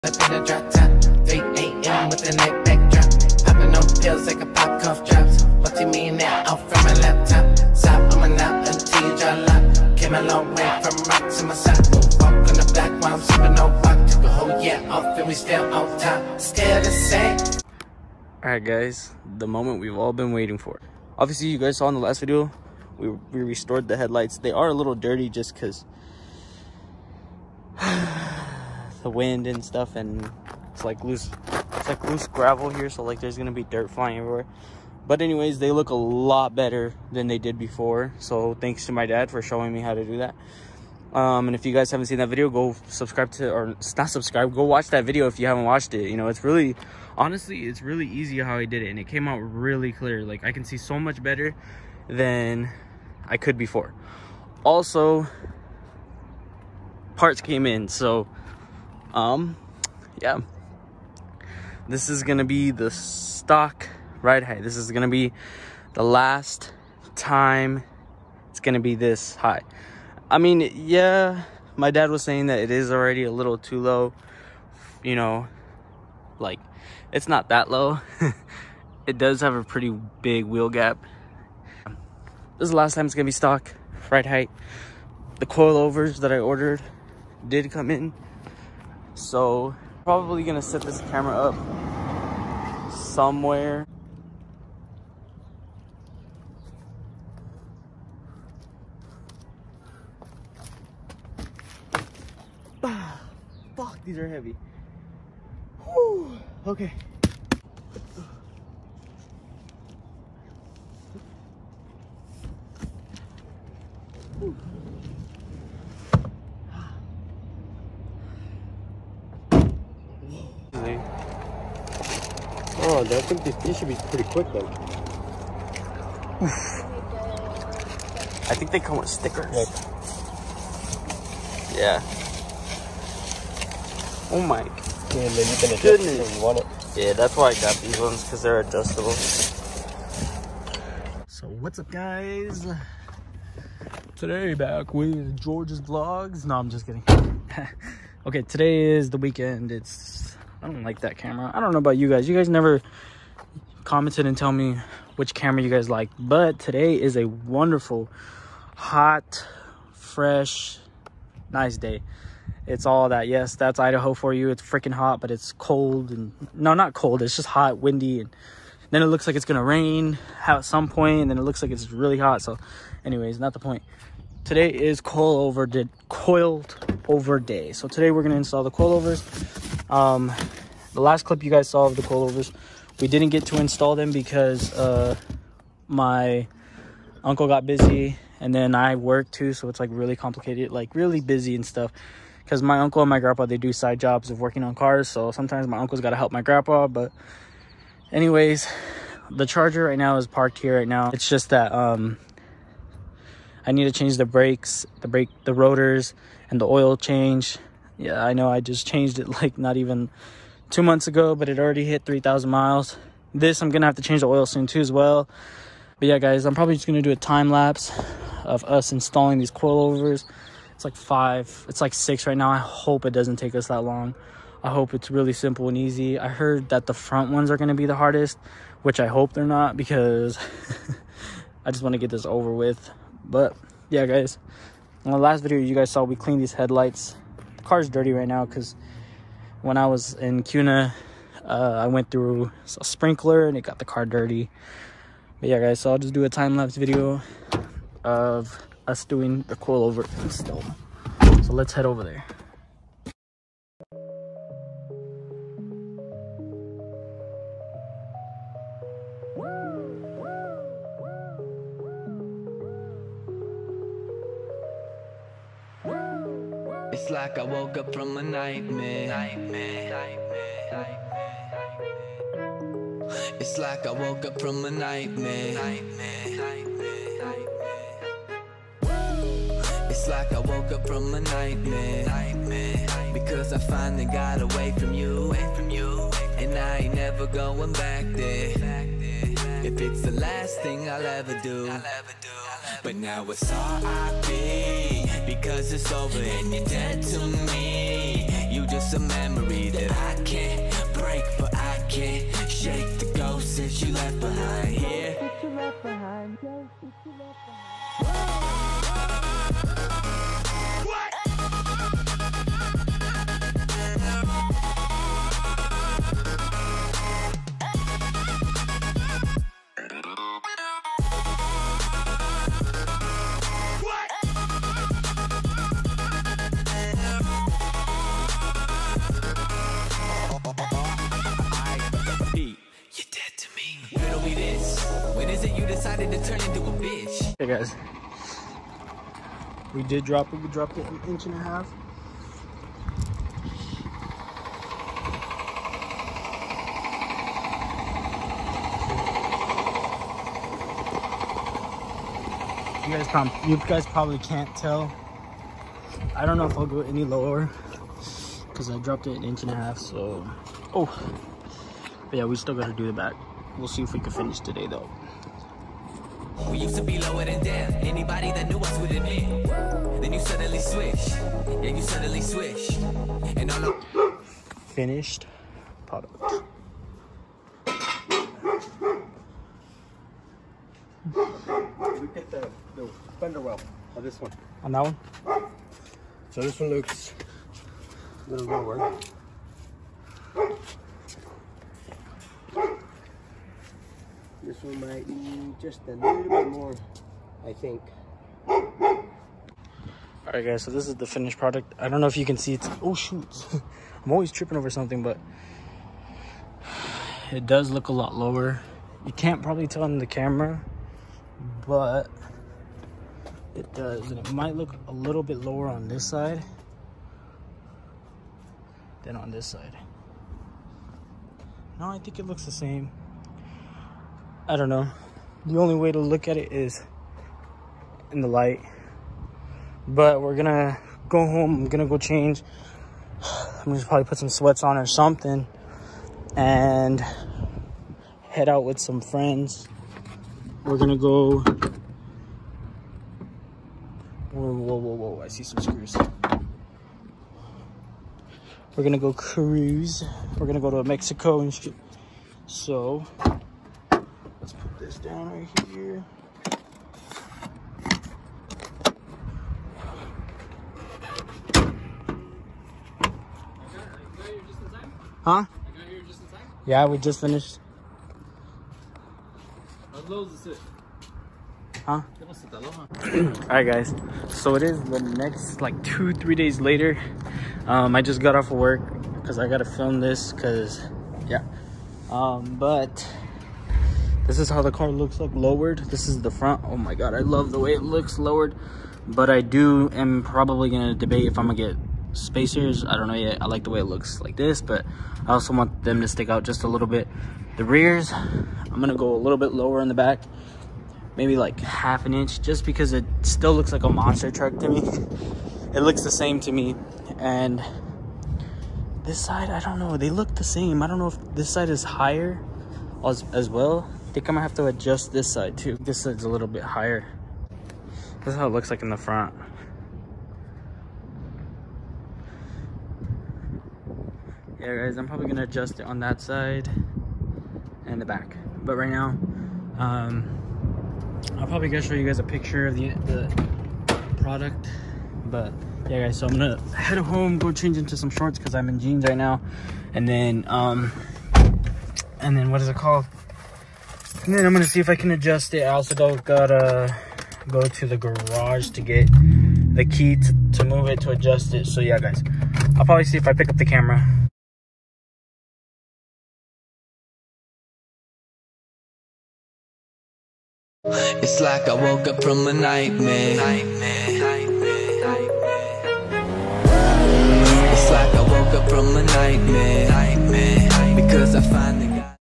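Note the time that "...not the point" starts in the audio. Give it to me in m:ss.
2:53.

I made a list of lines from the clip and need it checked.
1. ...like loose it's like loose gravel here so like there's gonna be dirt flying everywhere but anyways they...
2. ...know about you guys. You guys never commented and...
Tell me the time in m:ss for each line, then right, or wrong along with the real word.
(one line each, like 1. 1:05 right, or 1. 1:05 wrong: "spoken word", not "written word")
1. 0:30 right
2. 2:31 right.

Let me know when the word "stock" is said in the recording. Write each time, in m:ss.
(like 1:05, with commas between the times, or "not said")
1:02, 1:23.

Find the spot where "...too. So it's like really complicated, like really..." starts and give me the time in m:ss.
3:09.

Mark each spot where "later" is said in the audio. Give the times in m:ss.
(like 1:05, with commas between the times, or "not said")
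7:56.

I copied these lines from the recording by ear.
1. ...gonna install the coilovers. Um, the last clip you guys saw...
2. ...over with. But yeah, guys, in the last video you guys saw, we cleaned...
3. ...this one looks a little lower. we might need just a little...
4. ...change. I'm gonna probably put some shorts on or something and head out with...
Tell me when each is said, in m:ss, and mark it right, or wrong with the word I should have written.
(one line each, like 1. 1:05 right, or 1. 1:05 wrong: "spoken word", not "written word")
1. 2:58 right
2. 3:52 right
3. 6:26 right
4. 7:11 wrong: "sweats", not "shorts".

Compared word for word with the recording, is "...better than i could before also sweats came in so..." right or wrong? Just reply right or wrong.
wrong.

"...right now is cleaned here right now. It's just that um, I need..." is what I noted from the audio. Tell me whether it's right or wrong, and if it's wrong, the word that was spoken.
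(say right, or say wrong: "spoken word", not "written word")
wrong: "parked", not "cleaned".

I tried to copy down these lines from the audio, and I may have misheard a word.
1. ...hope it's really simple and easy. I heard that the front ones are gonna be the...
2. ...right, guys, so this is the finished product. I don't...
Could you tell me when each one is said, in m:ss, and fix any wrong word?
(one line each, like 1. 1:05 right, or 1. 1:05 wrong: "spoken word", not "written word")
1. 3:44 right
2. 6:40 right.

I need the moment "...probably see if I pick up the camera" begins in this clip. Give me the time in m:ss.
9:12.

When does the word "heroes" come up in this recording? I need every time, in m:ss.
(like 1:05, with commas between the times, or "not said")
not said.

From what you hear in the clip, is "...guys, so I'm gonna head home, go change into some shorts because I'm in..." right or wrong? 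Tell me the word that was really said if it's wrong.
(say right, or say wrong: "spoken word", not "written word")
right.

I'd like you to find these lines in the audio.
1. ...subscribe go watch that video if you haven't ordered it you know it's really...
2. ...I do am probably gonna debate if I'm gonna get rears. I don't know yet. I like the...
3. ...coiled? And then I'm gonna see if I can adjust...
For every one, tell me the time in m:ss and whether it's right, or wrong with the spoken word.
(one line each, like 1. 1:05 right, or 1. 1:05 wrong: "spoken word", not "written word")
1. 0:44 wrong: "watched", not "ordered"
2. 8:09 wrong: "spacers", not "rears"
3. 9:02 wrong: "called", not "coiled".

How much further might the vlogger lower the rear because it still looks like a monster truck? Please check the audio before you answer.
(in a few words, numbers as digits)
Half an inch.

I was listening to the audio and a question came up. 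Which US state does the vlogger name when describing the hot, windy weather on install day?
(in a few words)
Idaho.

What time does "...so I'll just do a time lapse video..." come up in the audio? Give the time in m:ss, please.
4:05.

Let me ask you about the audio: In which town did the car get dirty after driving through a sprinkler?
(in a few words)
Kuna.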